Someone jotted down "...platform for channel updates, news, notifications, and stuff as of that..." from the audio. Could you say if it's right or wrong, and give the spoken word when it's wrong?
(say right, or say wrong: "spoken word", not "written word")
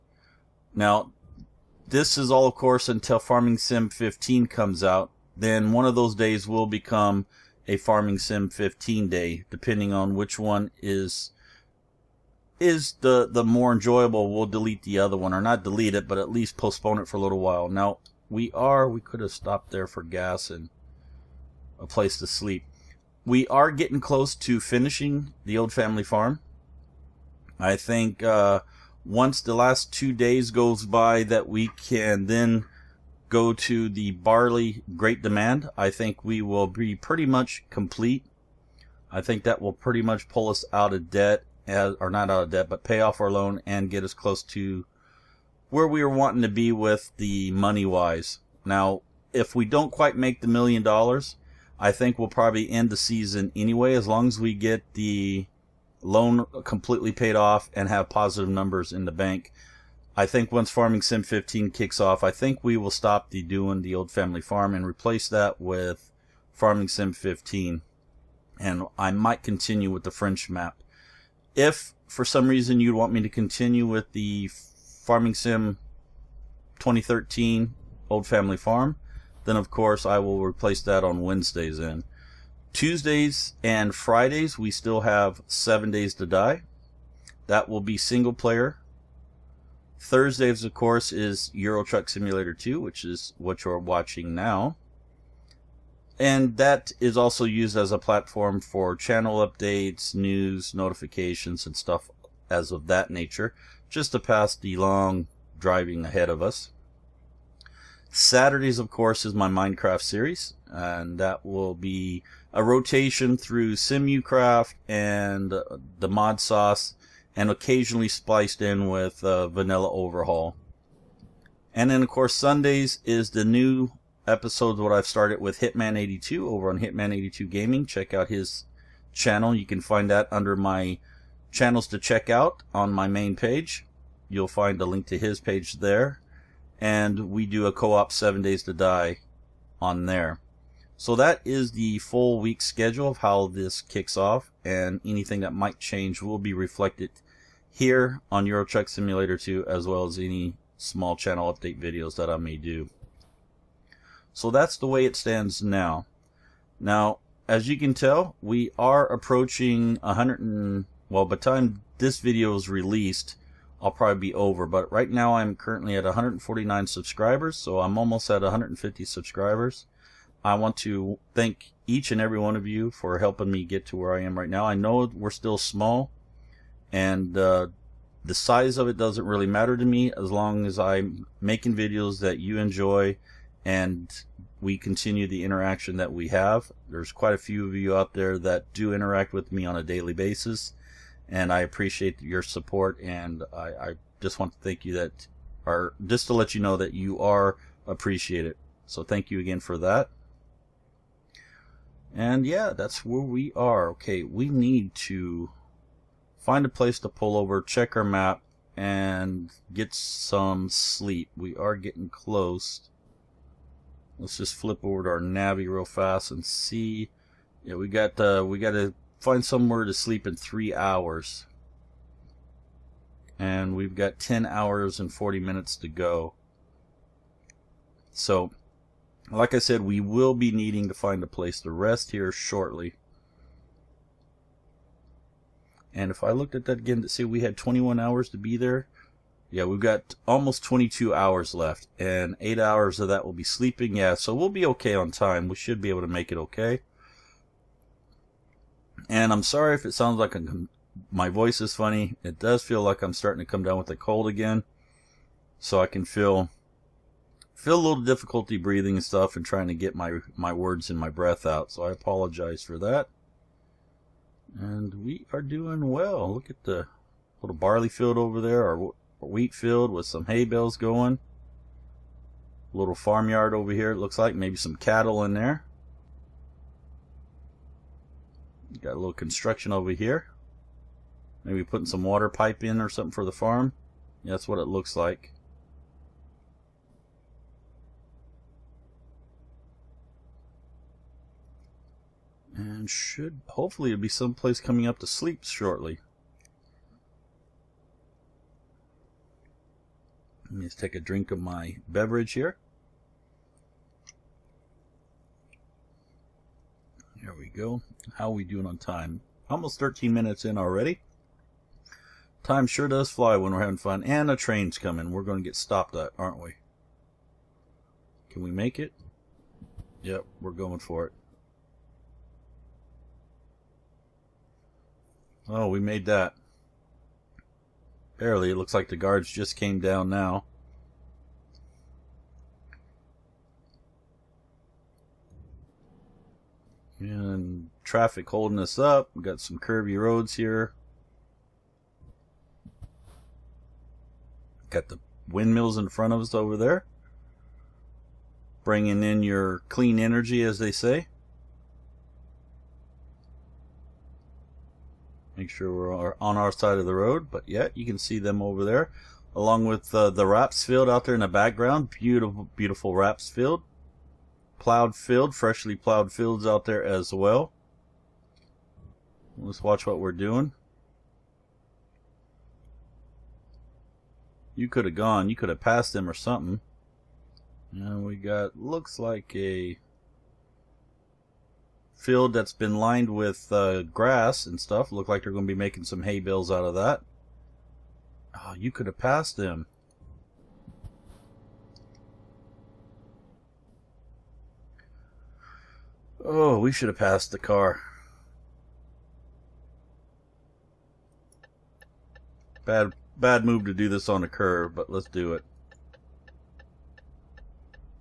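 right.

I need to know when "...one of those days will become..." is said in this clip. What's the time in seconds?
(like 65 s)
5 s.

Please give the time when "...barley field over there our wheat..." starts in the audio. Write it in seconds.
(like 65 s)
267 s.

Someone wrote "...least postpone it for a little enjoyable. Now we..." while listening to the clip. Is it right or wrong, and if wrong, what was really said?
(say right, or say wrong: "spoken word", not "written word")
wrong: "while", not "enjoyable".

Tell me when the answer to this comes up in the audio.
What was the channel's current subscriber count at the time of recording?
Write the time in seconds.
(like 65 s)
166 s.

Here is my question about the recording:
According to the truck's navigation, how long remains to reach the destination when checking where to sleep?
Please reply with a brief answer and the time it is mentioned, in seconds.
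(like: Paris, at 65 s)
10 hours 40 minutes, at 224 s.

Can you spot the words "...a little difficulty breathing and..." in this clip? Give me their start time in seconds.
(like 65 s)
257 s.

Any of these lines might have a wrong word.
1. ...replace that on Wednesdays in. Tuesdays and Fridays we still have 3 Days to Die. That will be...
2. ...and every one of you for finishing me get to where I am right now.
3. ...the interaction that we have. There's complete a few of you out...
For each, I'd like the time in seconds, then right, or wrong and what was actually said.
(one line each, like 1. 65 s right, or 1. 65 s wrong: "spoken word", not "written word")
1. 80 s wrong: "7", not "3"
2. 172 s wrong: "helping", not "finishing"
3. 185 s wrong: "quite", not "complete".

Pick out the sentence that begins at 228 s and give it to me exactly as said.
So like I said, we will be needing to find a place to rest here shortly.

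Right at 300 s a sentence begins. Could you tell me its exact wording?
Let me just take a drink of my beverage here.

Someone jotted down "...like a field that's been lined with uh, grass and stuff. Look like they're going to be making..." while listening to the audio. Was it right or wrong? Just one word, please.
right.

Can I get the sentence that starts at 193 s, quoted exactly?
And I, I just want to thank you that, or just to let you know that you are appreciated.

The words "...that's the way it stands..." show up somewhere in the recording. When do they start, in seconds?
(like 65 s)
154 s.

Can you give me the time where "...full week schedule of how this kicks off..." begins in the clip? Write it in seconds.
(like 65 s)
141 s.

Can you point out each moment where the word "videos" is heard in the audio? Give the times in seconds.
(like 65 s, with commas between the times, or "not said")
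151 s, 162 s, 181 s.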